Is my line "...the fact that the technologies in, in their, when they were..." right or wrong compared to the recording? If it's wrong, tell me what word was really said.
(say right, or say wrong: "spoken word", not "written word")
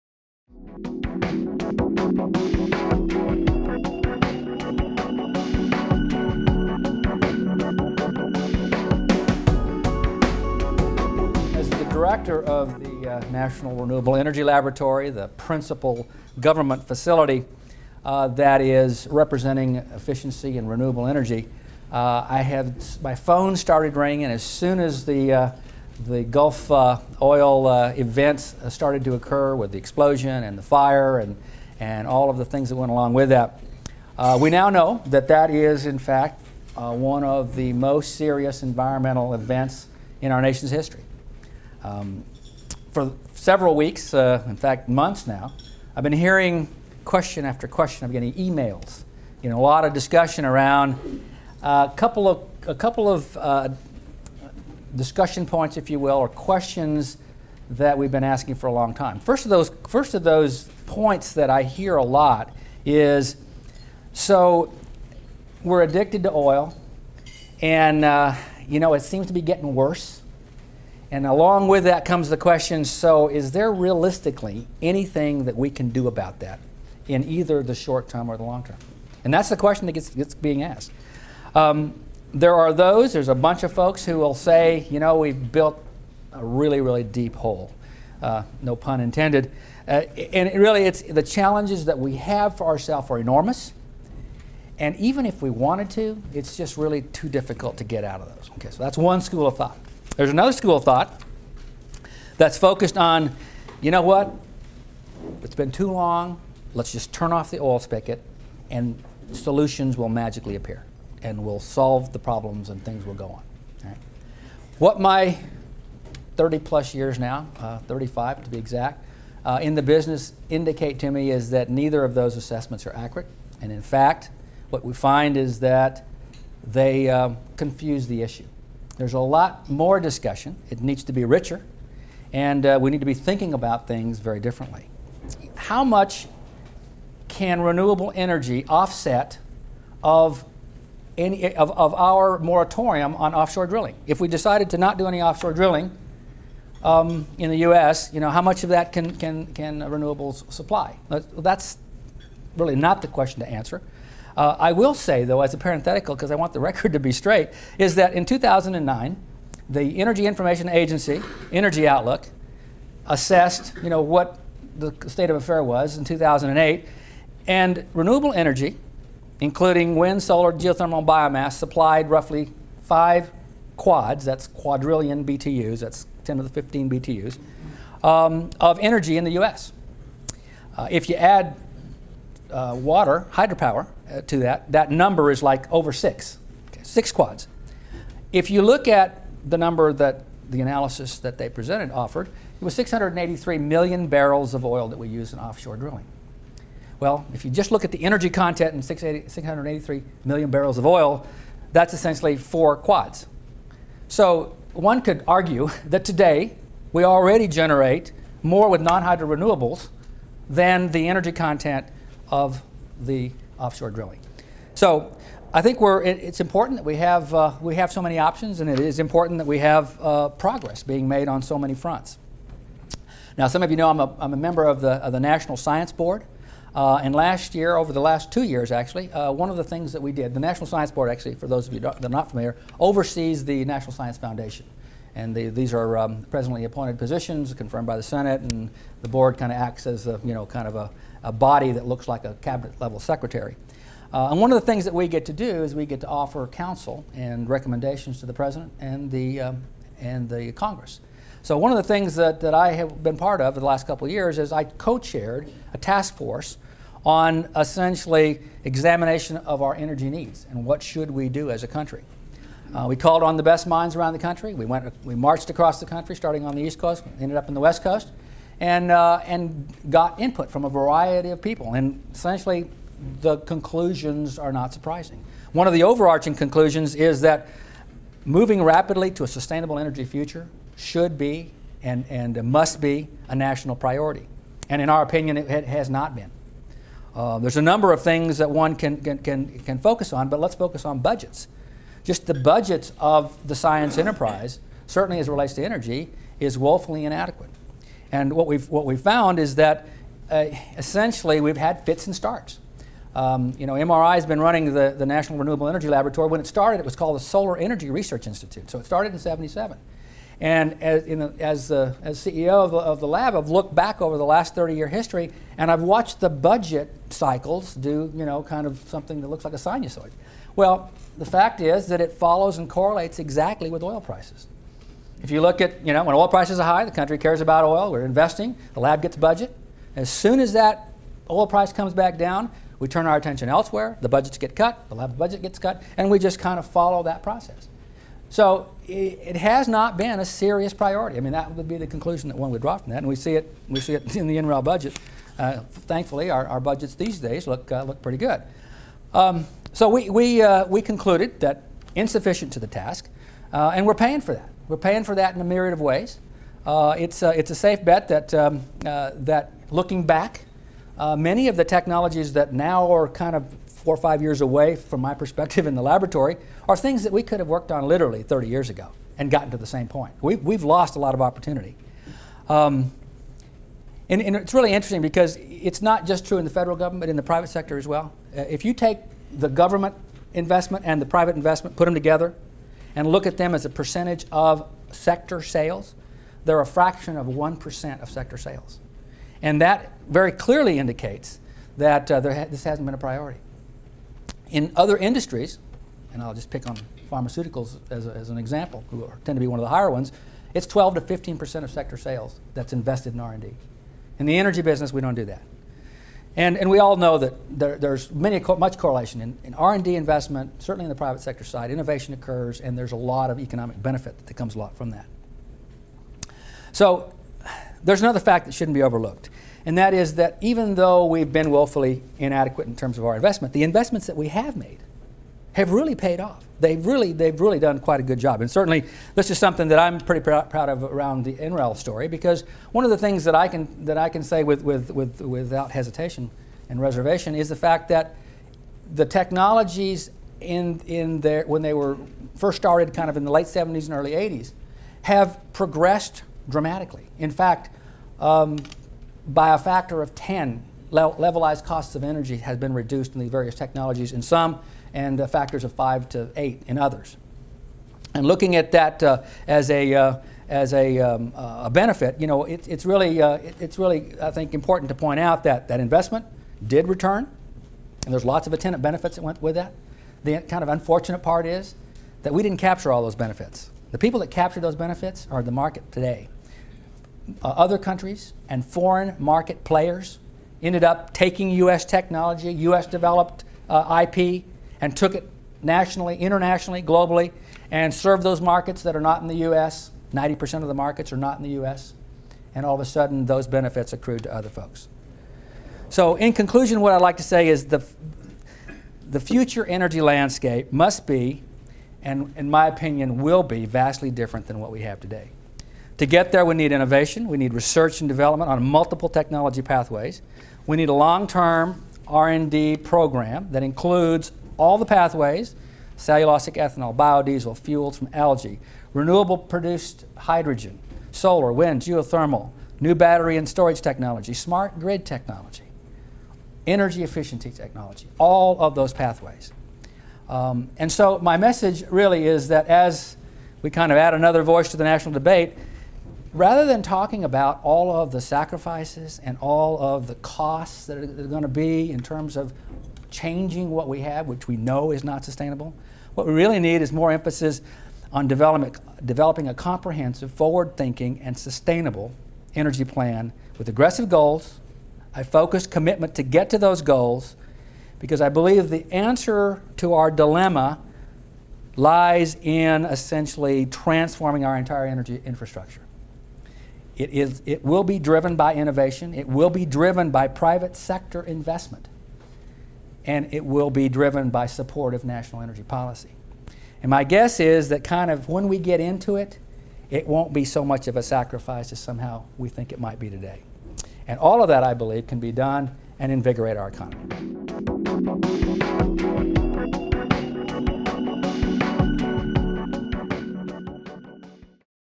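right.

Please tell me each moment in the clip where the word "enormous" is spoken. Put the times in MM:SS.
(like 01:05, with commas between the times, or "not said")
01:33.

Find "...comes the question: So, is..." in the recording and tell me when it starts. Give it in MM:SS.
01:12.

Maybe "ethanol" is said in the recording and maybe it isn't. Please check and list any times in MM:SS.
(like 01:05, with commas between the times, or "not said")
08:36.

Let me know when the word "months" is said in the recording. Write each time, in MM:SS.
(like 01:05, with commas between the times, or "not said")
00:44.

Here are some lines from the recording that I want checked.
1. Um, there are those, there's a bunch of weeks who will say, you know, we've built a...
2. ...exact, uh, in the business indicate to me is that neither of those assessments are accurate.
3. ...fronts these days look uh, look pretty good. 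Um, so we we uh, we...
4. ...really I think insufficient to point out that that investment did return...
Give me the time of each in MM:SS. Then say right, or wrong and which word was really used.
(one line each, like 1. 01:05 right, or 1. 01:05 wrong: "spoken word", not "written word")
1. 01:21 wrong: "folks", not "weeks"
2. 01:58 right
3. 05:46 wrong: "budgets", not "fronts"
4. 07:43 wrong: "important", not "insufficient".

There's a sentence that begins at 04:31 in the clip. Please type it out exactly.
And essentially, the conclusions are not surprising.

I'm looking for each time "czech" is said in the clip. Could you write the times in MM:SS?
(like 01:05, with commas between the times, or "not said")
not said.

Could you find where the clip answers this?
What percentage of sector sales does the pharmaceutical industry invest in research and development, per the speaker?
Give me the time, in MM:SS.
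06:40.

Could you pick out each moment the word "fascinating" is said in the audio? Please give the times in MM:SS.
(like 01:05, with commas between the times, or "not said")
not said.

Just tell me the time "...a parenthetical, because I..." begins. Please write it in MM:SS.
02:35.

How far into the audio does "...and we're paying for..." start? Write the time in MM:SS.
05:53.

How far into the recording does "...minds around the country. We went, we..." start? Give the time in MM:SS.
04:23.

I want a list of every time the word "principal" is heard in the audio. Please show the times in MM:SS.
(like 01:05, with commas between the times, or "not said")
00:15.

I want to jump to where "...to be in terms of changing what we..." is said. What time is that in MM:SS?
09:01.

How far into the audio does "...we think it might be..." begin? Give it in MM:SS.
09:42.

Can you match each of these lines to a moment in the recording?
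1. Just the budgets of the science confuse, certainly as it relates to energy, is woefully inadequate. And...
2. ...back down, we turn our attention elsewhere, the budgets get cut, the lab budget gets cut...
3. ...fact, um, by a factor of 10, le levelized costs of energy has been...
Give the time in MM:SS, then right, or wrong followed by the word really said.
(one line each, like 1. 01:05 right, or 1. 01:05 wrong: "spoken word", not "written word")
1. 04:52 wrong: "enterprise", not "confuse"
2. 05:31 right
3. 07:27 right.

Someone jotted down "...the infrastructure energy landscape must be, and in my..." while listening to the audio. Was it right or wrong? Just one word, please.
wrong.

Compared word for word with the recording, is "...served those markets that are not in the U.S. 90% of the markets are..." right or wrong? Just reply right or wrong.
right.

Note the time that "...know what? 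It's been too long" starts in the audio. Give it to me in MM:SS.
01:43.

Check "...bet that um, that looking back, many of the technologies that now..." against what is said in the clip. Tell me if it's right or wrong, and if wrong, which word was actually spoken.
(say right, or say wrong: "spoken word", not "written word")
right.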